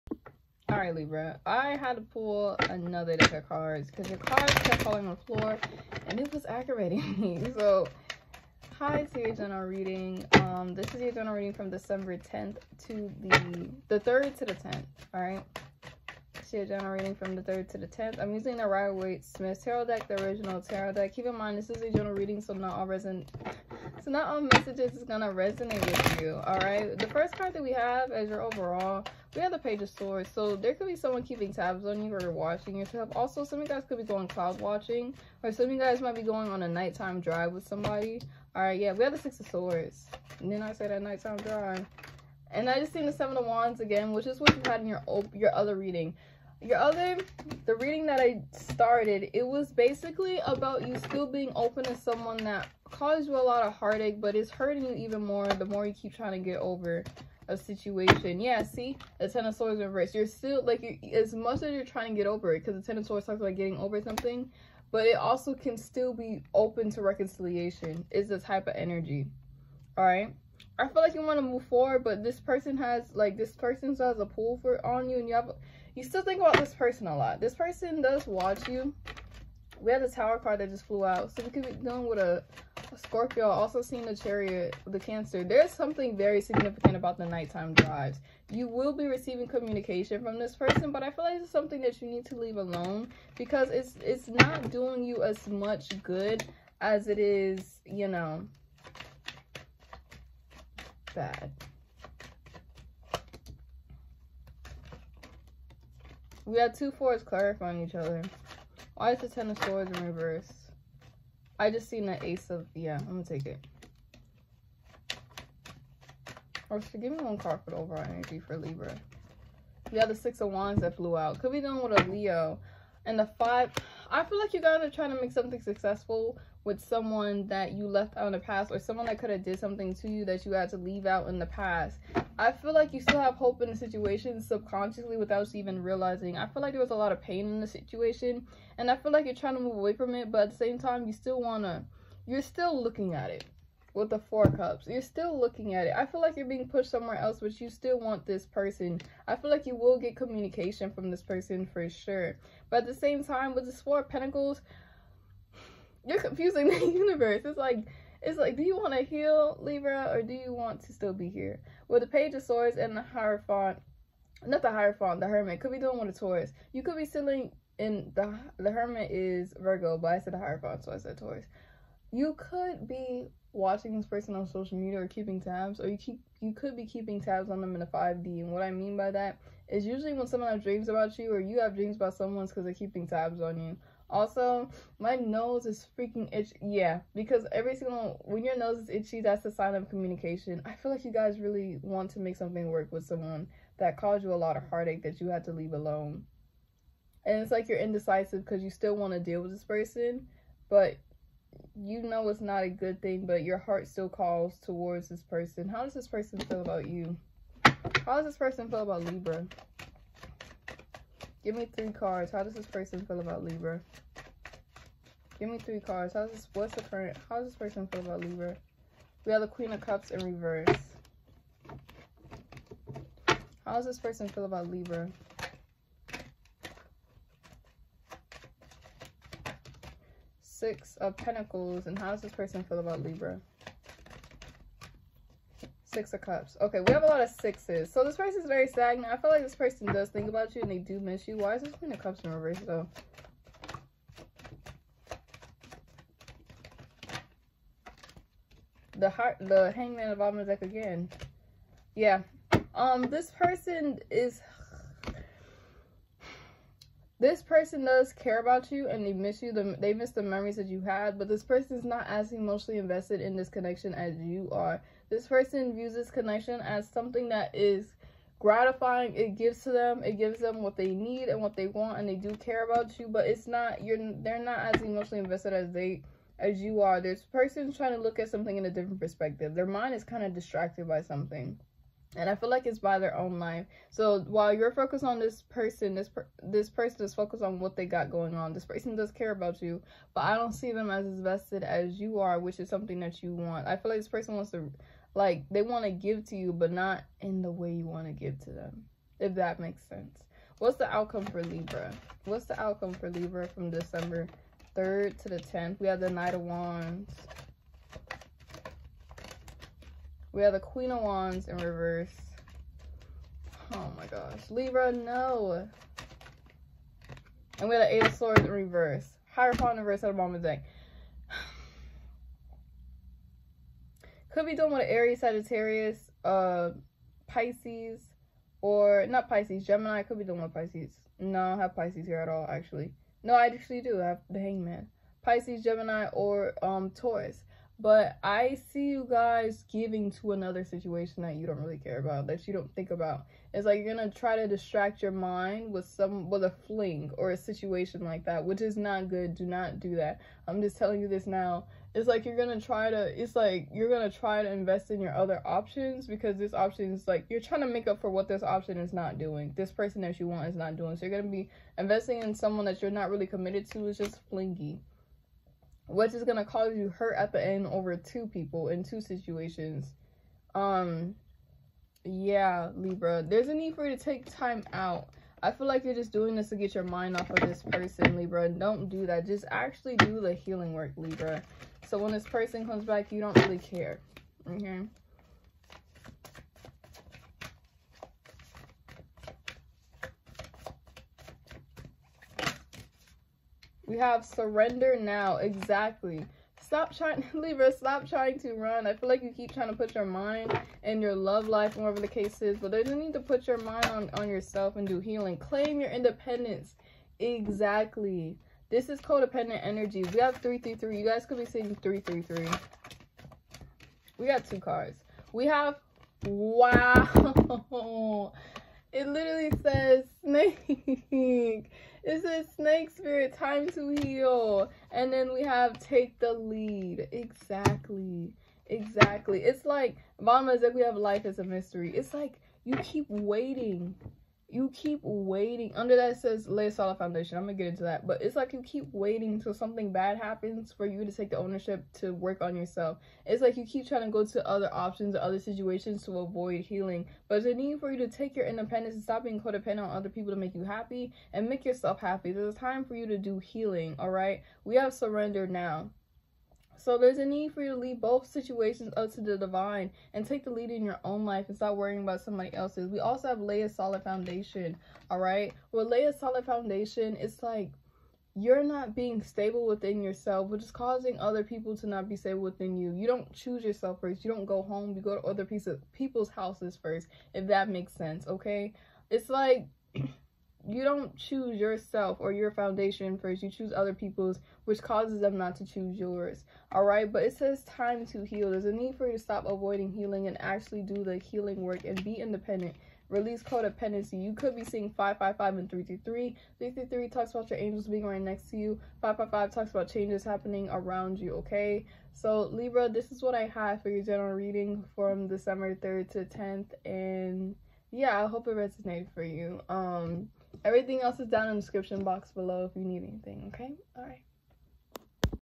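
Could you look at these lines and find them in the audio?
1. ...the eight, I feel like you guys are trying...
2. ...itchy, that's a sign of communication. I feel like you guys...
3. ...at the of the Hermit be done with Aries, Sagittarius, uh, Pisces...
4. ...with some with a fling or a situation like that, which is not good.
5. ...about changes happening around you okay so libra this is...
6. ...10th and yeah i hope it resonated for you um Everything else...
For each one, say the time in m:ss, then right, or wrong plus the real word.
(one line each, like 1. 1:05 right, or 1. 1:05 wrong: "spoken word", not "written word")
1. 2:03 wrong: "five", not "eight"
2. 3:08 right
3. 5:20 wrong: "Could", not "Hermit"
4. 5:45 right
5. 8:19 right
6. 8:26 right.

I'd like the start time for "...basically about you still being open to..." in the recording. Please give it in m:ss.
0:49.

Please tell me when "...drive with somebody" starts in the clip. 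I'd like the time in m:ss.
0:37.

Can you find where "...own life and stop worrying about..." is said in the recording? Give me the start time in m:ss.
7:41.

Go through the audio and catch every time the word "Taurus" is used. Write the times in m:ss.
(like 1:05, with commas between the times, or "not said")
2:46, 2:51, 5:36.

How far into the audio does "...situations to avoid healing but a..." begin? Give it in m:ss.
7:25.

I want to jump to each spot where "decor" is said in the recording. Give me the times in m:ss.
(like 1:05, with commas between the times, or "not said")
not said.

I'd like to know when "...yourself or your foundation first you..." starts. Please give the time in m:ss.
8:01.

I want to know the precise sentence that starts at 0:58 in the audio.
Yeah, see, the Ten of Swords reverse.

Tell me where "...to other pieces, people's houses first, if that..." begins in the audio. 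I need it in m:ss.
7:55.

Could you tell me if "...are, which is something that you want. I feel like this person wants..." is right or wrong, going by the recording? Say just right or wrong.
right.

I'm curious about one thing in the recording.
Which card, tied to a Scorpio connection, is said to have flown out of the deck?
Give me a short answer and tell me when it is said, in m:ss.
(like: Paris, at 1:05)
tower card, at 1:20.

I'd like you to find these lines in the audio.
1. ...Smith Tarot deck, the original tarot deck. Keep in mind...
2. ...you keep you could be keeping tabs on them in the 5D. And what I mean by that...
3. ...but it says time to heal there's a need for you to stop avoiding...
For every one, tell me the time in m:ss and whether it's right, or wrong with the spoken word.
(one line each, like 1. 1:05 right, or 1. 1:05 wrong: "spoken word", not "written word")
1. 0:19 right
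2. 2:55 right
3. 8:07 right.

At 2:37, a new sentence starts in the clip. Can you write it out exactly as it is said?
It's like it's like, do you want to heal Libra or do you want to still be here?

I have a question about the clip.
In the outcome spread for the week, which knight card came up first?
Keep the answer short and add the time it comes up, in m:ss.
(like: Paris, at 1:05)
Knight of Wands, at 5:06.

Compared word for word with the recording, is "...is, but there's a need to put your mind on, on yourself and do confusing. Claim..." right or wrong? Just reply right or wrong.
wrong.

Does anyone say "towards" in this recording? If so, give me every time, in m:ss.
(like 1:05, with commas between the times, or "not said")
3:24.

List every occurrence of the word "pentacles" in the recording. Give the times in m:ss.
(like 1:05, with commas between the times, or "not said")
2:34, 3:51.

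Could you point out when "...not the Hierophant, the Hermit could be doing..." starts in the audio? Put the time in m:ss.
2:44.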